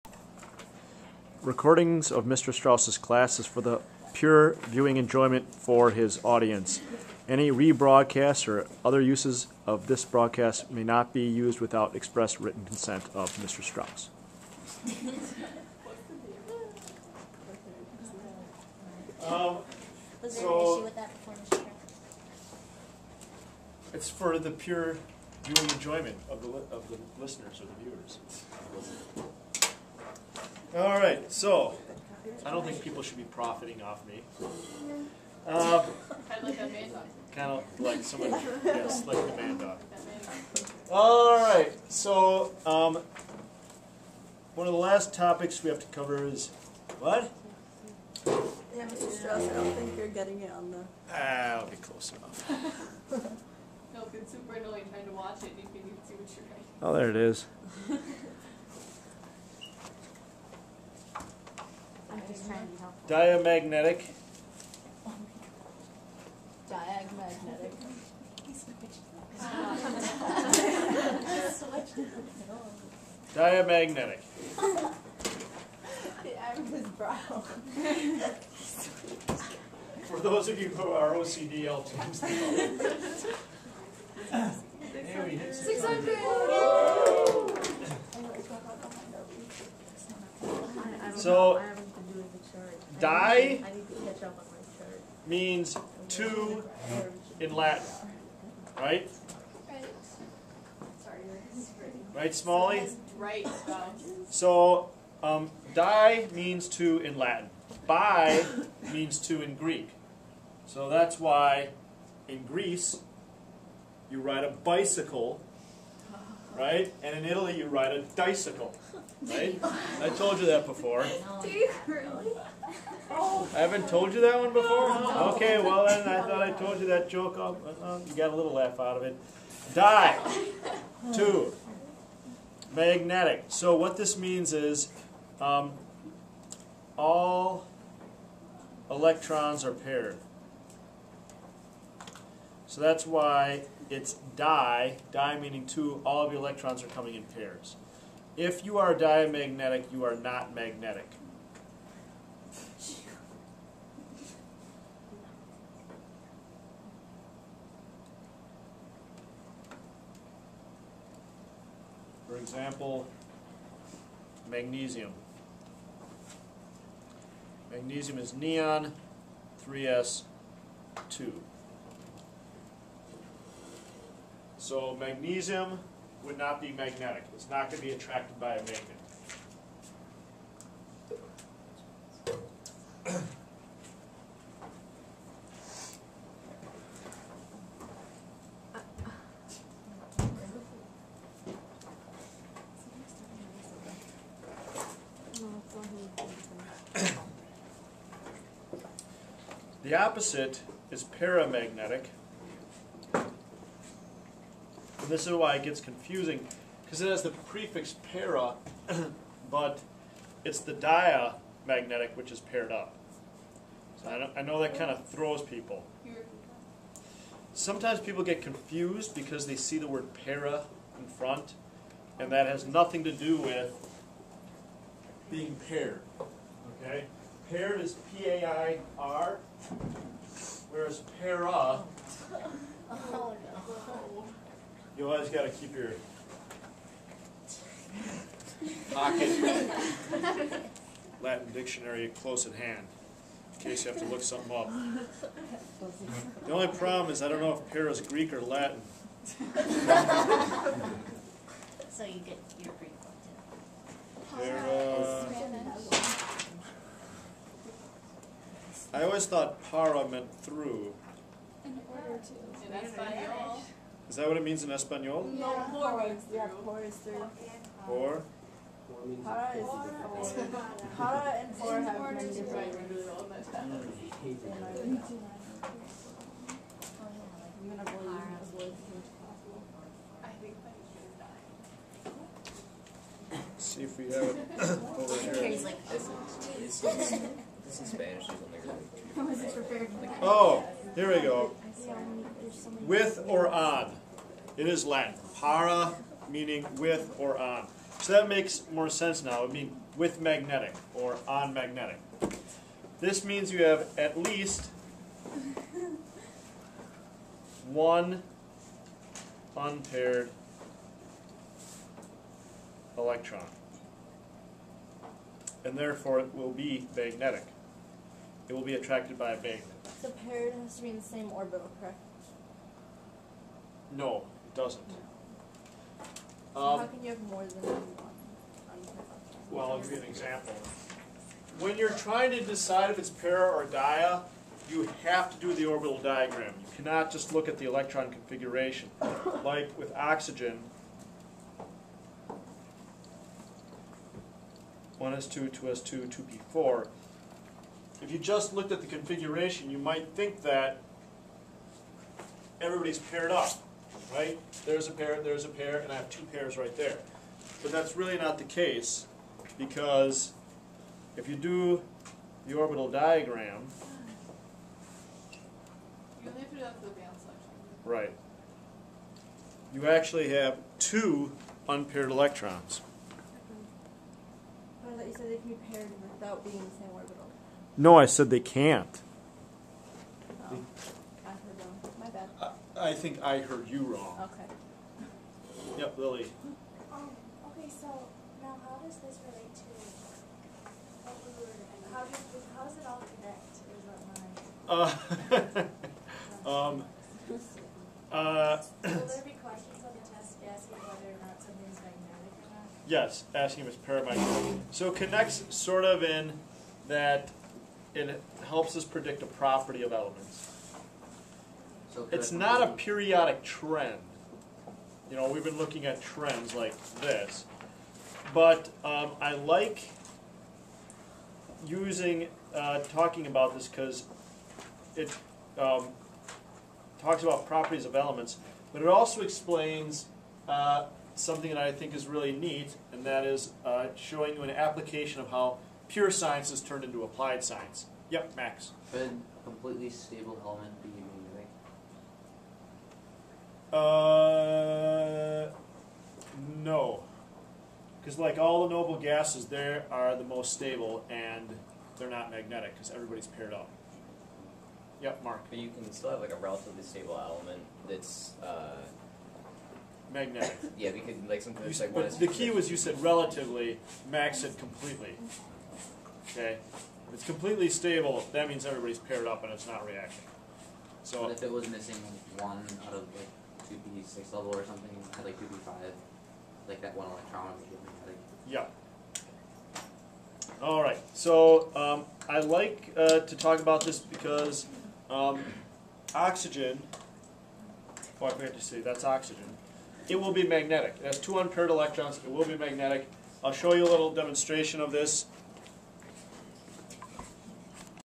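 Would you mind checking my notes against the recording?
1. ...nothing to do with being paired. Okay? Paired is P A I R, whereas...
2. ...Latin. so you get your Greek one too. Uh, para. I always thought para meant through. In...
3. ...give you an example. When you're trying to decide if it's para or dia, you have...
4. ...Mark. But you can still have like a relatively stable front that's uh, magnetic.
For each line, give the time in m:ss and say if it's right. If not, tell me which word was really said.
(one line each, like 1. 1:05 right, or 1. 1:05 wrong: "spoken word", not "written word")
1. 3:42 right
2. 4:08 right
3. 5:29 right
4. 7:35 wrong: "element", not "front".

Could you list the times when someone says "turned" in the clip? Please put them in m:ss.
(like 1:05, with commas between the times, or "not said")
7:16.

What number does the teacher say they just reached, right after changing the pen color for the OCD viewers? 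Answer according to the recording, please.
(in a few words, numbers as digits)
600.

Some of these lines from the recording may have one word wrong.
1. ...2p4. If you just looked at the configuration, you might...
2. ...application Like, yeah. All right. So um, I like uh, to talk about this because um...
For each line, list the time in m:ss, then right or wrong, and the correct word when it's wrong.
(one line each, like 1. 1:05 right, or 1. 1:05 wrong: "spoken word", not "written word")
1. 5:46 right
2. 7:57 wrong: "electron", not "application".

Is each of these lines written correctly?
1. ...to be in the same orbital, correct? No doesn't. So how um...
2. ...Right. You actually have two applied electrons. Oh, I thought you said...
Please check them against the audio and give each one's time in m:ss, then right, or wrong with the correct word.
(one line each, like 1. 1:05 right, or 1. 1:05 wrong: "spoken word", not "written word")
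1. 5:20 right
2. 6:07 wrong: "unpaired", not "applied".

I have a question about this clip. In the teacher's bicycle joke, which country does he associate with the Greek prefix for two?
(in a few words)
Greece.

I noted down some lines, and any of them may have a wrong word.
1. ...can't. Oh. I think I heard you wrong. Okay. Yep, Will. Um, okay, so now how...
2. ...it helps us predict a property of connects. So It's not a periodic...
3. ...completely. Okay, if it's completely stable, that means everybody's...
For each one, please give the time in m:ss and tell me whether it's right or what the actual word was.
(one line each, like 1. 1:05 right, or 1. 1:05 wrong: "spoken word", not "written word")
1. 6:18 wrong: "Lily", not "Will"
2. 6:47 wrong: "elements", not "connects"
3. 7:44 right.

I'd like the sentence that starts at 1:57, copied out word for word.
And in Italy, you ride a bicycle, right?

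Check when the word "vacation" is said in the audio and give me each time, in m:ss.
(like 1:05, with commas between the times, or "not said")
not said.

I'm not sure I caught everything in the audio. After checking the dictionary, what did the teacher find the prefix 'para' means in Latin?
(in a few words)
with or on.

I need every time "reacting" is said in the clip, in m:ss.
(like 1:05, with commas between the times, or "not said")
7:49.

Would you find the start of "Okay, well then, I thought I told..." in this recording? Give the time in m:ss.
2:05.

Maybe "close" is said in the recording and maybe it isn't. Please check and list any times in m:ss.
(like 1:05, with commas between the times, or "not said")
0:51, 4:02.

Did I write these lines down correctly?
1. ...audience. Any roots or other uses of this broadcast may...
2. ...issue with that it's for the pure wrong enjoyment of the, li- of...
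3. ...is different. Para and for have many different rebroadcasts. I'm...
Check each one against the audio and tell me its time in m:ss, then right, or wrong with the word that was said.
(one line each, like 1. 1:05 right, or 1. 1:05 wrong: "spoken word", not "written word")
1. 0:06 wrong: "rebroadcasts", not "roots"
2. 0:20 wrong: "viewing", not "wrong"
3. 4:29 wrong: "roots", not "rebroadcasts".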